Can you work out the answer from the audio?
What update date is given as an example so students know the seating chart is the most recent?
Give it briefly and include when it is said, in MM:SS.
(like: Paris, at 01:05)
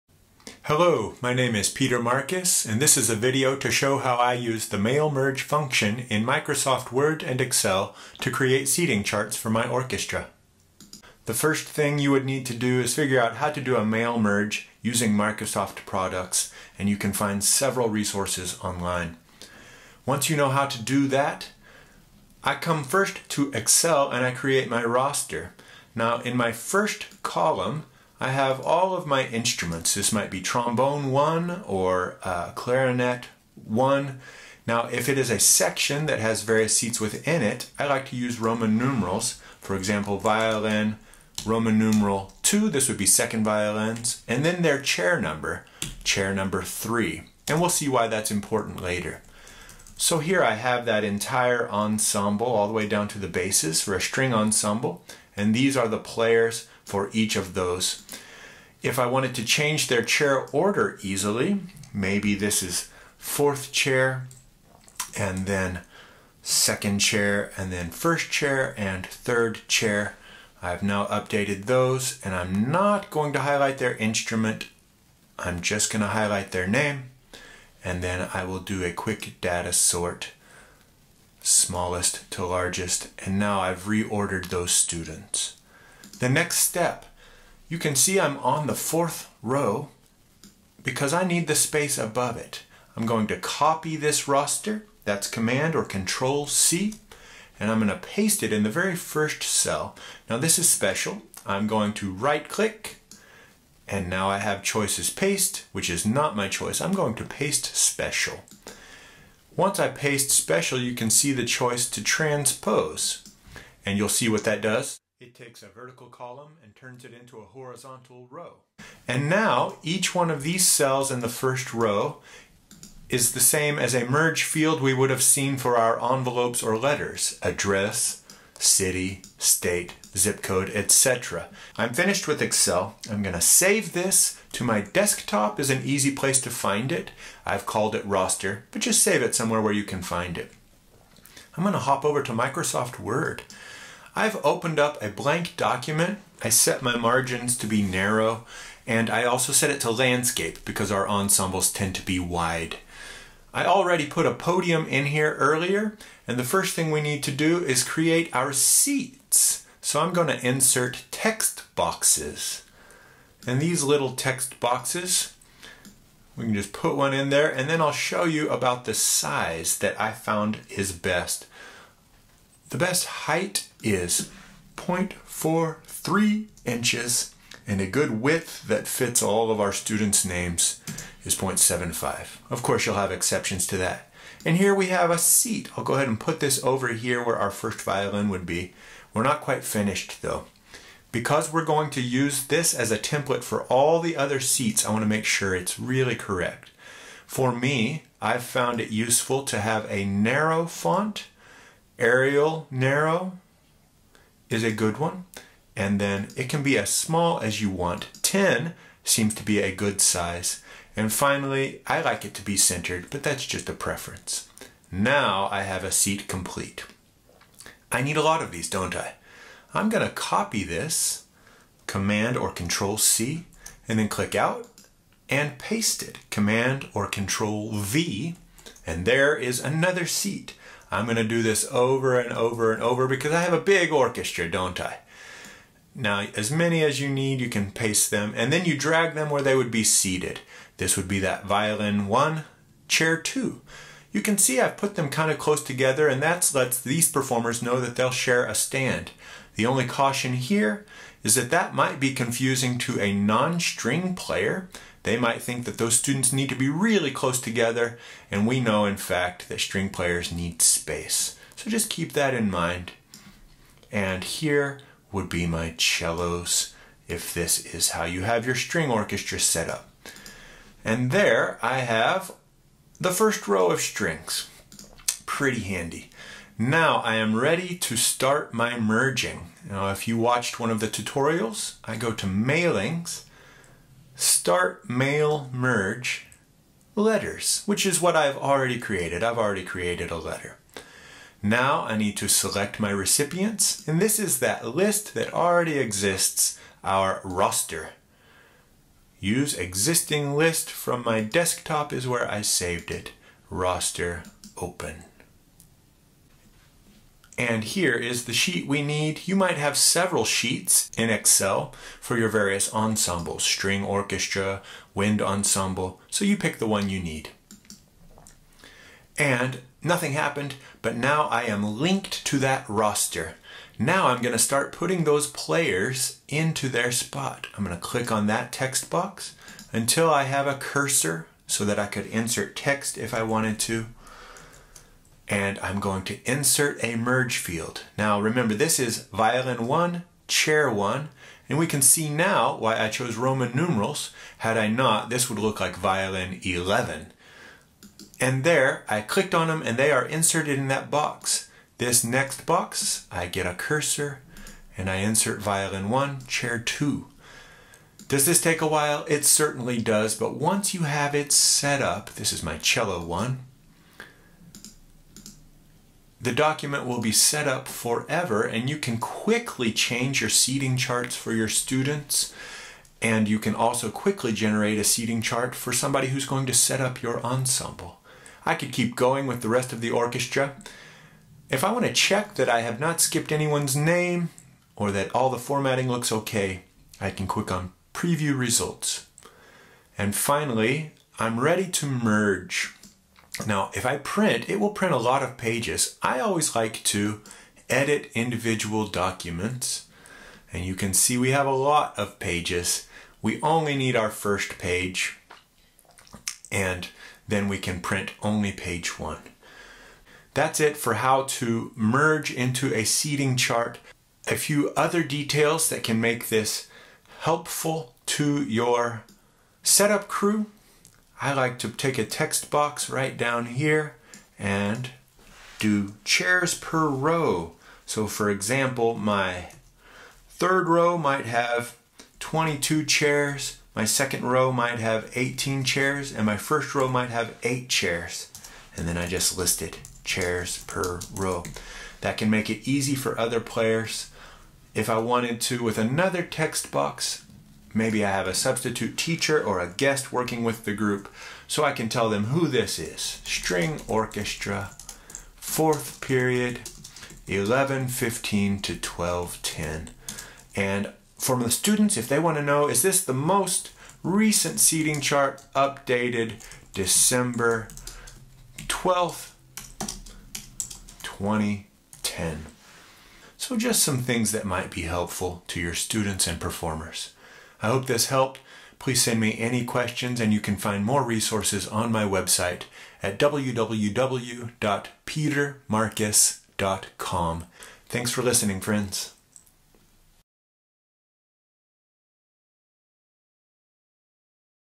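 December 12th 2010, at 07:46.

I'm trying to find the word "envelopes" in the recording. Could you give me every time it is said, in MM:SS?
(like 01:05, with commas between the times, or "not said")
02:06.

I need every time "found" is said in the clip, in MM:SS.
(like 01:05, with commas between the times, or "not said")
02:50, 03:18.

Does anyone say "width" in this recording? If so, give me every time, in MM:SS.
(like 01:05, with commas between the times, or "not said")
02:58.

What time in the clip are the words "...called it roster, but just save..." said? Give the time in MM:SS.
02:17.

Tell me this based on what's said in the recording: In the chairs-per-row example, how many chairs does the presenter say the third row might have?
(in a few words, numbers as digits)
22.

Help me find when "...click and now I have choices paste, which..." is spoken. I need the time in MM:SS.
01:42.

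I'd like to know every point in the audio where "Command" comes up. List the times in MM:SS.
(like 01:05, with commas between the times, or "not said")
01:35, 03:41, 03:46.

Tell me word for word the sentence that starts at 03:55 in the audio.
Now, as many as you need, you can paste them, and then you drag them where they would be seated.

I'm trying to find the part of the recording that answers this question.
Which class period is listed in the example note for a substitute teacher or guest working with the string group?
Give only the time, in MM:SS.
07:35.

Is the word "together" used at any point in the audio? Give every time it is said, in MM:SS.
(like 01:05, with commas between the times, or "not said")
04:05, 04:17.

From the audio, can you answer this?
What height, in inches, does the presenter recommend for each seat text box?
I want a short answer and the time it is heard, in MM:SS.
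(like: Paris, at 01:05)
0.43 inches, at 02:54.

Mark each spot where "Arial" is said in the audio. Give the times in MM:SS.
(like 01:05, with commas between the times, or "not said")
03:22.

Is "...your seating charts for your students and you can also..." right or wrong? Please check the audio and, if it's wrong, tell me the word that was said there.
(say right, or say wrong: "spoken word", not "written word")
right.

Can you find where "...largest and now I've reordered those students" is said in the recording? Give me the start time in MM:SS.
01:22.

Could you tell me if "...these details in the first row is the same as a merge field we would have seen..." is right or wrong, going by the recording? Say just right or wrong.
wrong.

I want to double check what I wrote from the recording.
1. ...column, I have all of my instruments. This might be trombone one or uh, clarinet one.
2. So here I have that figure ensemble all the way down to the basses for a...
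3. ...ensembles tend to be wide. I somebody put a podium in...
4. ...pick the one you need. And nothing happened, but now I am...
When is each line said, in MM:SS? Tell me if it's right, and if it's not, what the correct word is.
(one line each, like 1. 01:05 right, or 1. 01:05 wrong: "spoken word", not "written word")
1. 00:27 right
2. 00:49 wrong: "entire", not "figure"
3. 02:31 wrong: "already", not "somebody"
4. 05:16 right.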